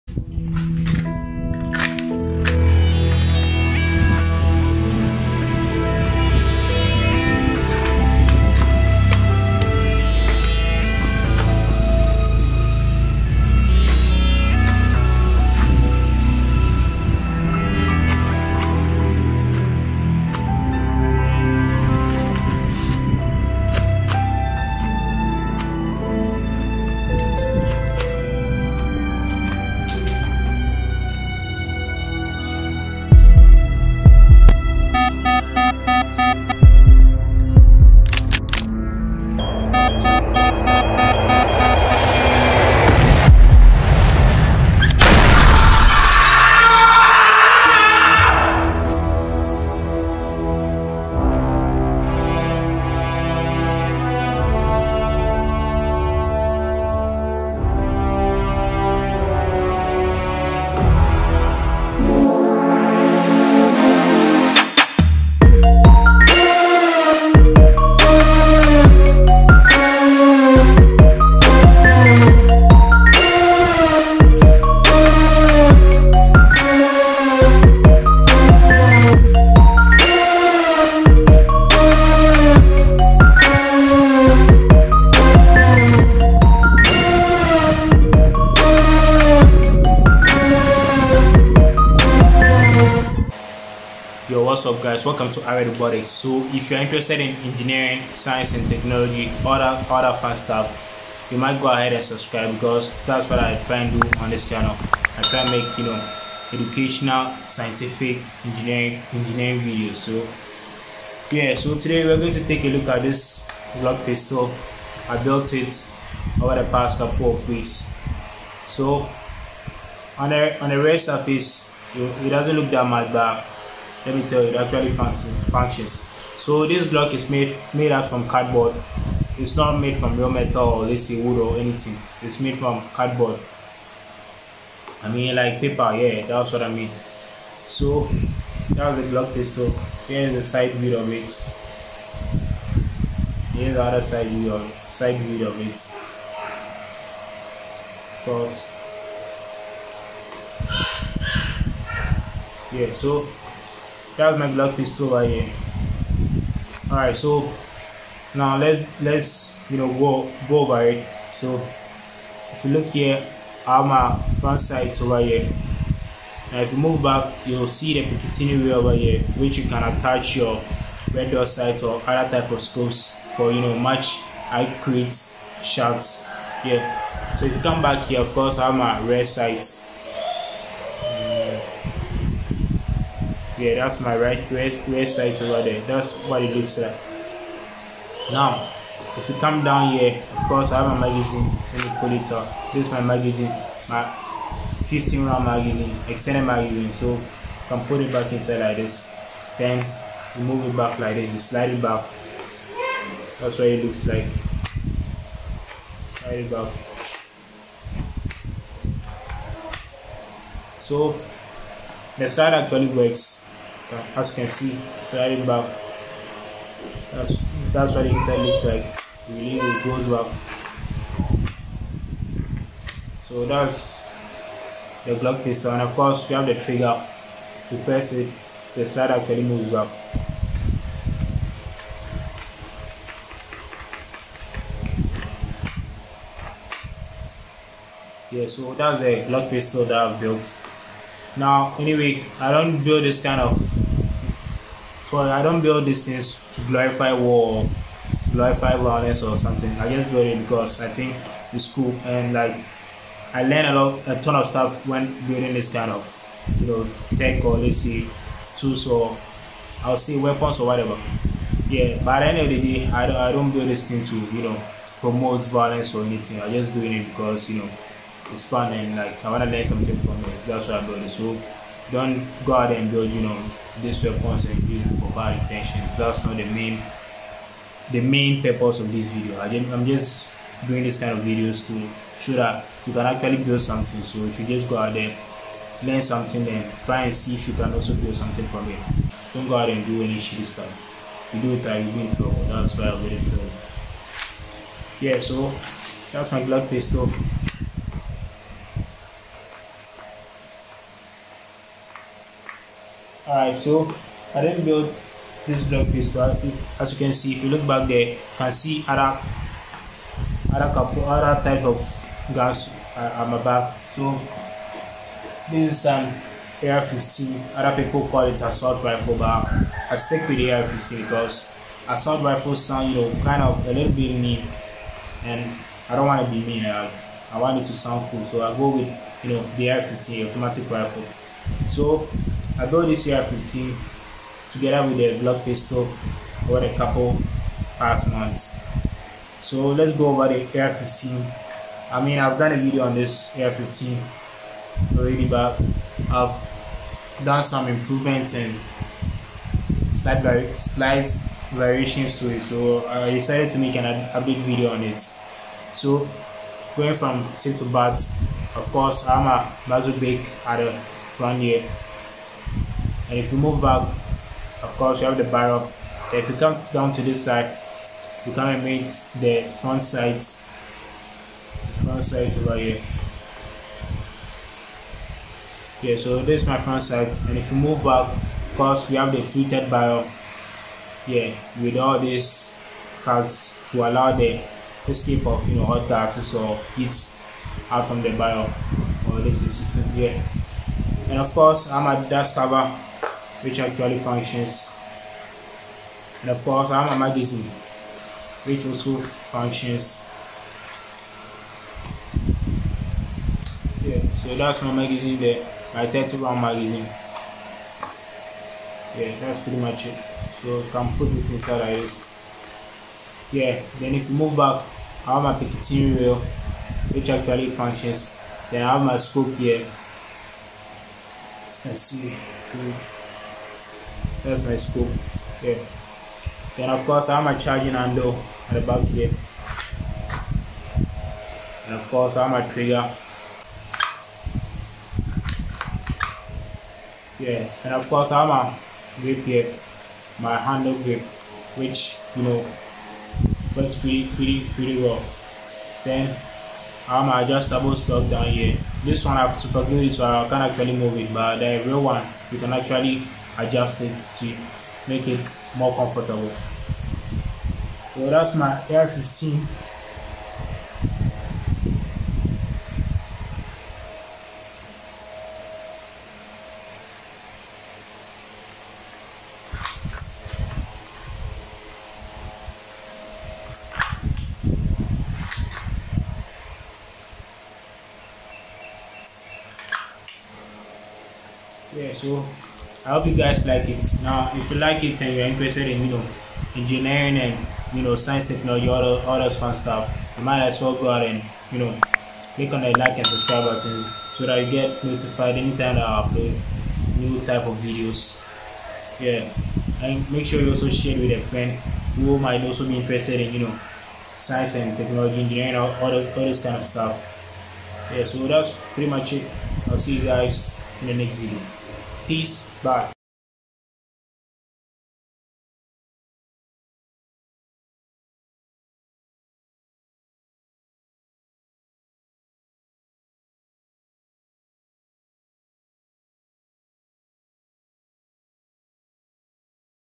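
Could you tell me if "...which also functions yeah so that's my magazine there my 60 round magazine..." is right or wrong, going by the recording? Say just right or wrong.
wrong.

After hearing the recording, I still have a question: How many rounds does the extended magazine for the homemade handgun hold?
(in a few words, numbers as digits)
15.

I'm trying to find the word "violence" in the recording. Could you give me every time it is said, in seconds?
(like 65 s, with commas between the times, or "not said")
248 s, 265 s.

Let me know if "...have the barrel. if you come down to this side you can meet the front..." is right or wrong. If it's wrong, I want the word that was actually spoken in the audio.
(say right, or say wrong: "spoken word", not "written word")
right.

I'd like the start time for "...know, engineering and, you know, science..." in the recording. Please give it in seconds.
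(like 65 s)
485 s.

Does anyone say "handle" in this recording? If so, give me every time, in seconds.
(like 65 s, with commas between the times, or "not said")
427 s, 440 s.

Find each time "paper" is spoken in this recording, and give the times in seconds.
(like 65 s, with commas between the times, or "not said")
135 s.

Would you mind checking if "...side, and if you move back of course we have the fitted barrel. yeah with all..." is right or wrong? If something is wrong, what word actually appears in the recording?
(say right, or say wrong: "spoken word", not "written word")
right.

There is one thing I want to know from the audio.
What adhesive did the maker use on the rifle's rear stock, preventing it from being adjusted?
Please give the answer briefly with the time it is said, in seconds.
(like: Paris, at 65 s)
Super glue, at 449 s.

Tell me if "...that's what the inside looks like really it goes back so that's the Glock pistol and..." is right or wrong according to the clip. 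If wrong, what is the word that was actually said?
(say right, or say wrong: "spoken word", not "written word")
right.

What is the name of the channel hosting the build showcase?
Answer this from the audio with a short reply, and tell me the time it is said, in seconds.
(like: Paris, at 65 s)
Array Robotics, at 95 s.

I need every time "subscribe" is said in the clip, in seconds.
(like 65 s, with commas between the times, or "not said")
102 s, 493 s.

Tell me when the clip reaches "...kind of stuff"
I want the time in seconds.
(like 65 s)
506 s.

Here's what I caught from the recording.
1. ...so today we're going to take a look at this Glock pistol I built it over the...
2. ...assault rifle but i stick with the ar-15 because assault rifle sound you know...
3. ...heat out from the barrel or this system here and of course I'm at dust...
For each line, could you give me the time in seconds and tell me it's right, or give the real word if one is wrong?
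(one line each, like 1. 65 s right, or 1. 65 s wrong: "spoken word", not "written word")
1. 111 s right
2. 318 s right
3. 386 s right.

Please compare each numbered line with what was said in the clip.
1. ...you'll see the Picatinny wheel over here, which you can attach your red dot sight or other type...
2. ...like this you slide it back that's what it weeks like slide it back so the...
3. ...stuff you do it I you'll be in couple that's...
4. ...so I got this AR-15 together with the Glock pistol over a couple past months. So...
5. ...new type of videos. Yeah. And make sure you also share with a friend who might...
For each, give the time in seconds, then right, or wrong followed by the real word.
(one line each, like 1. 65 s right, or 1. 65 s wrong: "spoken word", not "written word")
1. 167 s right
2. 200 s wrong: "looks", not "weeks"
3. 290 s wrong: "trouble", not "couple"
4. 331 s right
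5. 496 s right.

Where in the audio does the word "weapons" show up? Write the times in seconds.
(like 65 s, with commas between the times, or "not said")
260 s, 274 s.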